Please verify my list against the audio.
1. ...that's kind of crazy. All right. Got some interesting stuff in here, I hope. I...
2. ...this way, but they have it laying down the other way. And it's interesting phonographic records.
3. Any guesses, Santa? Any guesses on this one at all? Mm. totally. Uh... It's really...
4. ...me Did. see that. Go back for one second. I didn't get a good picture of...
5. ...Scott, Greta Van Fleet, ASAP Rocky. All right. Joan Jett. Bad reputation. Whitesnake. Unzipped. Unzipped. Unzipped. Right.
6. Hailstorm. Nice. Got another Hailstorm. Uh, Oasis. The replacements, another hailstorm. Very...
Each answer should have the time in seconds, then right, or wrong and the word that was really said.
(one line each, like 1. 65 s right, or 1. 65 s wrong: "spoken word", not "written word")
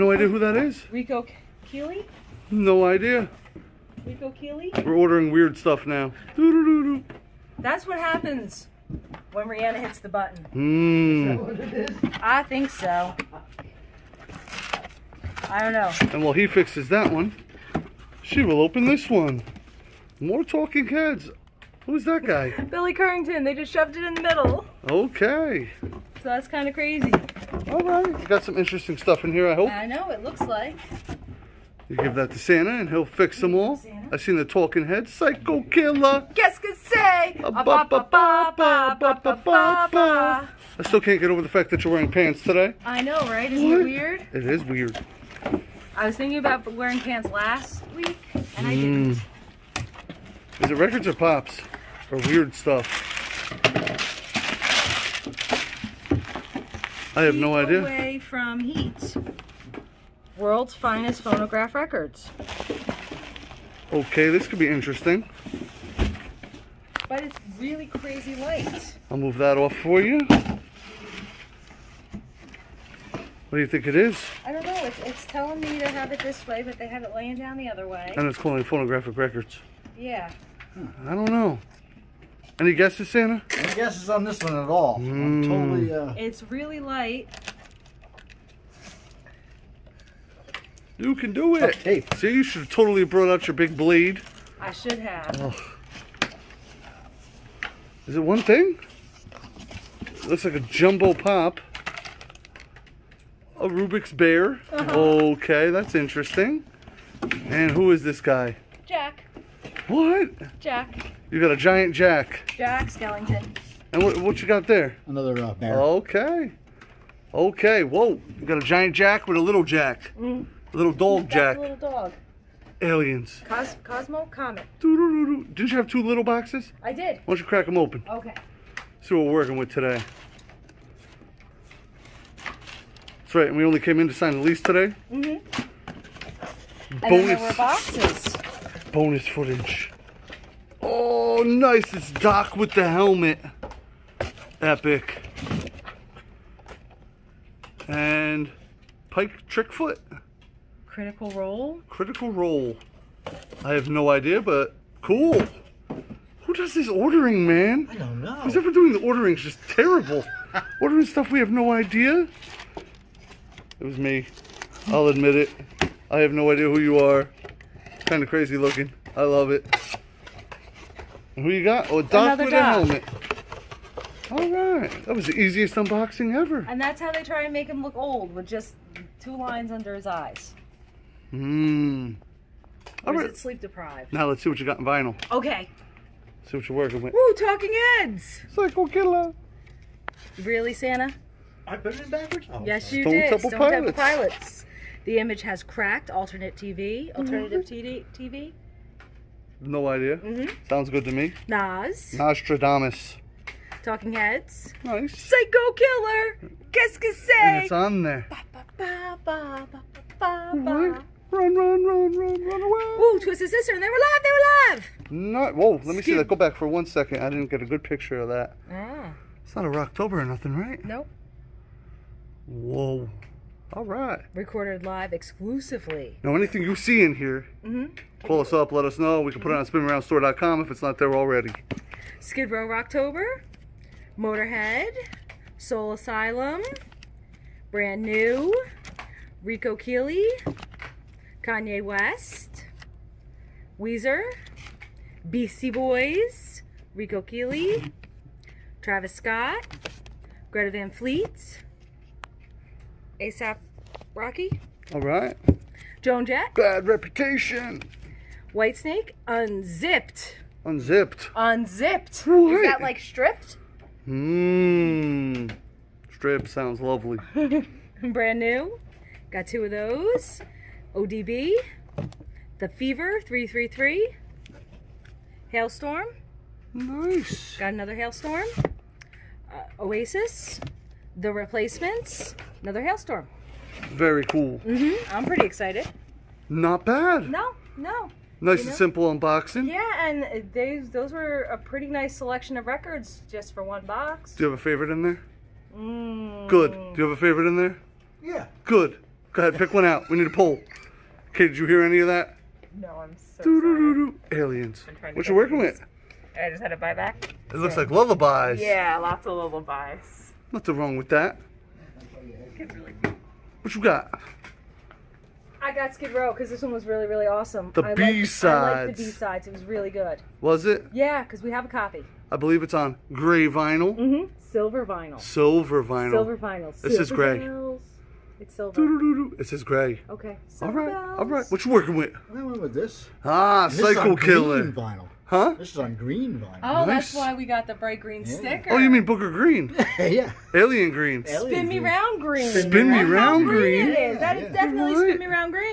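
1. 26 s right
2. 76 s wrong: "calling", not "interesting"
3. 82 s right
4. 215 s wrong: "Skip", not "Did"
5. 249 s right
6. 275 s right.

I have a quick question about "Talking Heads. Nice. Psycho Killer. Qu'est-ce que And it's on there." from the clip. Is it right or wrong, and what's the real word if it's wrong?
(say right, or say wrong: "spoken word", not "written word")
right.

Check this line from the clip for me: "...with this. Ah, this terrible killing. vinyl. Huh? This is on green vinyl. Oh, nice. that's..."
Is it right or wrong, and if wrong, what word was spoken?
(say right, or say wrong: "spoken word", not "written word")
wrong: "cycle", not "terrible".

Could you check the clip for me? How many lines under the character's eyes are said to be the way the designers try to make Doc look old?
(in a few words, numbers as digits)
2.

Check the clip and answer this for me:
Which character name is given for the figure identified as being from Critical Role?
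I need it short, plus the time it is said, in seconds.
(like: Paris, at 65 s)
Pike Trickfoot, at 149 s.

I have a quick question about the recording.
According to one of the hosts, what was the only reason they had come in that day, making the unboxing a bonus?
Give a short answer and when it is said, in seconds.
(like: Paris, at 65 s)
To sign the lease, at 134 s.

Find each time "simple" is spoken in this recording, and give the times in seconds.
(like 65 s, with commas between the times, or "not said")
288 s.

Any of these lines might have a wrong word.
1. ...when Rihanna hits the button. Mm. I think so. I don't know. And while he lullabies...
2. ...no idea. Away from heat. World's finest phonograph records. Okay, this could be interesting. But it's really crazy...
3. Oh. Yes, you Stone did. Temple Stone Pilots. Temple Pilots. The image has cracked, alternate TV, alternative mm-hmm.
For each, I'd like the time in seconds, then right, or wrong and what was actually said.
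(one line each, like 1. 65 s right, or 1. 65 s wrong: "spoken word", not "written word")
1. 9 s wrong: "fixes", not "lullabies"
2. 57 s right
3. 192 s right.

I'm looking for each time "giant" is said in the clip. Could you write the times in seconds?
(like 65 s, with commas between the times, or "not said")
111 s, 118 s.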